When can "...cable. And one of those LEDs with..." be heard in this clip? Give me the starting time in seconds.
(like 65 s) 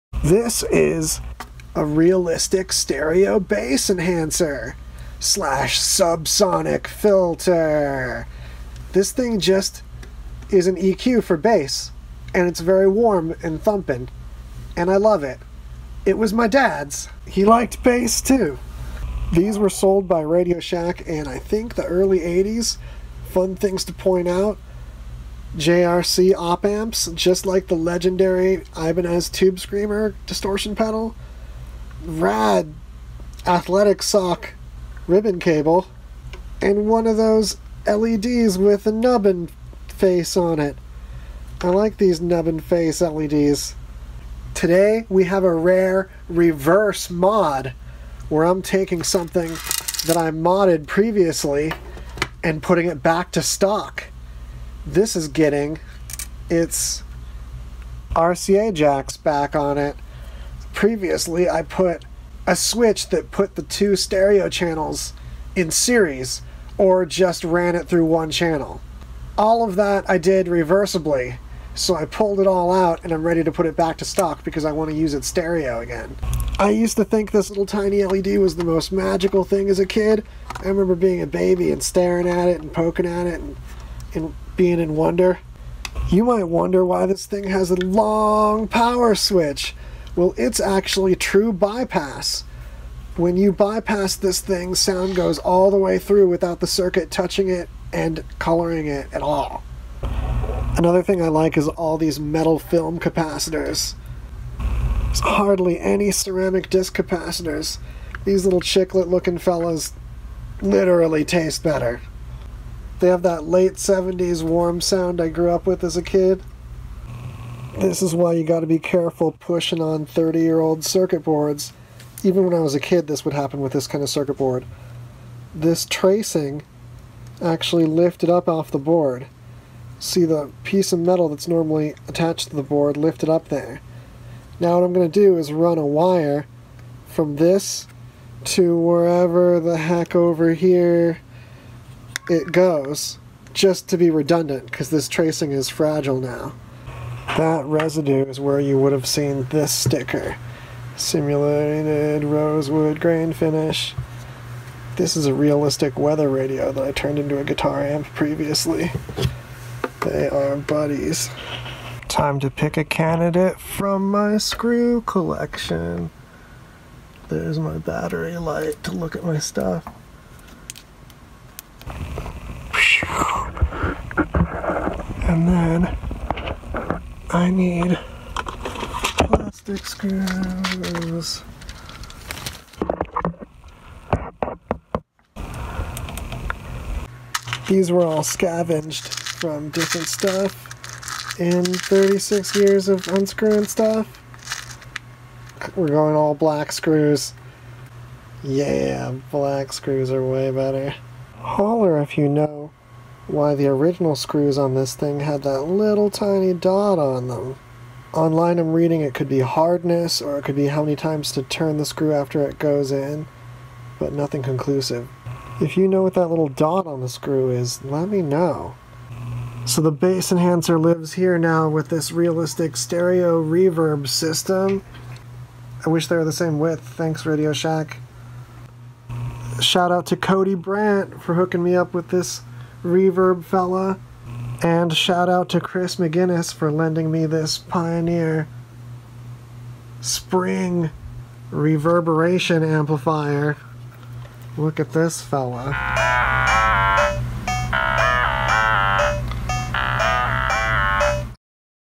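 35 s.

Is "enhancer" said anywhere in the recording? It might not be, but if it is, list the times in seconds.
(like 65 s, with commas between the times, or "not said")
3 s, 220 s.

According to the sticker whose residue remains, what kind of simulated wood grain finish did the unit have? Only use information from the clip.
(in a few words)
Rosewood.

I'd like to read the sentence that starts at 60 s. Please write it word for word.
Previously, I put a switch that put the two stereo channels in series or just ran it through one channel.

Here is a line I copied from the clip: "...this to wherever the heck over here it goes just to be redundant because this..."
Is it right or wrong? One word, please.
right.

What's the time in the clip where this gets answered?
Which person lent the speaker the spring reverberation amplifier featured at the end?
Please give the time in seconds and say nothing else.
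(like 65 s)
235 s.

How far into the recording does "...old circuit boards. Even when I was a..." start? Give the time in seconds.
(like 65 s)
120 s.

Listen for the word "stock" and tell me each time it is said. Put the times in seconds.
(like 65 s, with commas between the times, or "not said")
53 s, 74 s.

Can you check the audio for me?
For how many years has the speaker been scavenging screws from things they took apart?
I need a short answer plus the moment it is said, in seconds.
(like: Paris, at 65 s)
36, at 191 s.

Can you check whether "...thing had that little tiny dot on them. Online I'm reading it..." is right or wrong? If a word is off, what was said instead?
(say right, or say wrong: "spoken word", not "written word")
right.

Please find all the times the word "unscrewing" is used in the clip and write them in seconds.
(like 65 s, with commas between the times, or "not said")
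193 s.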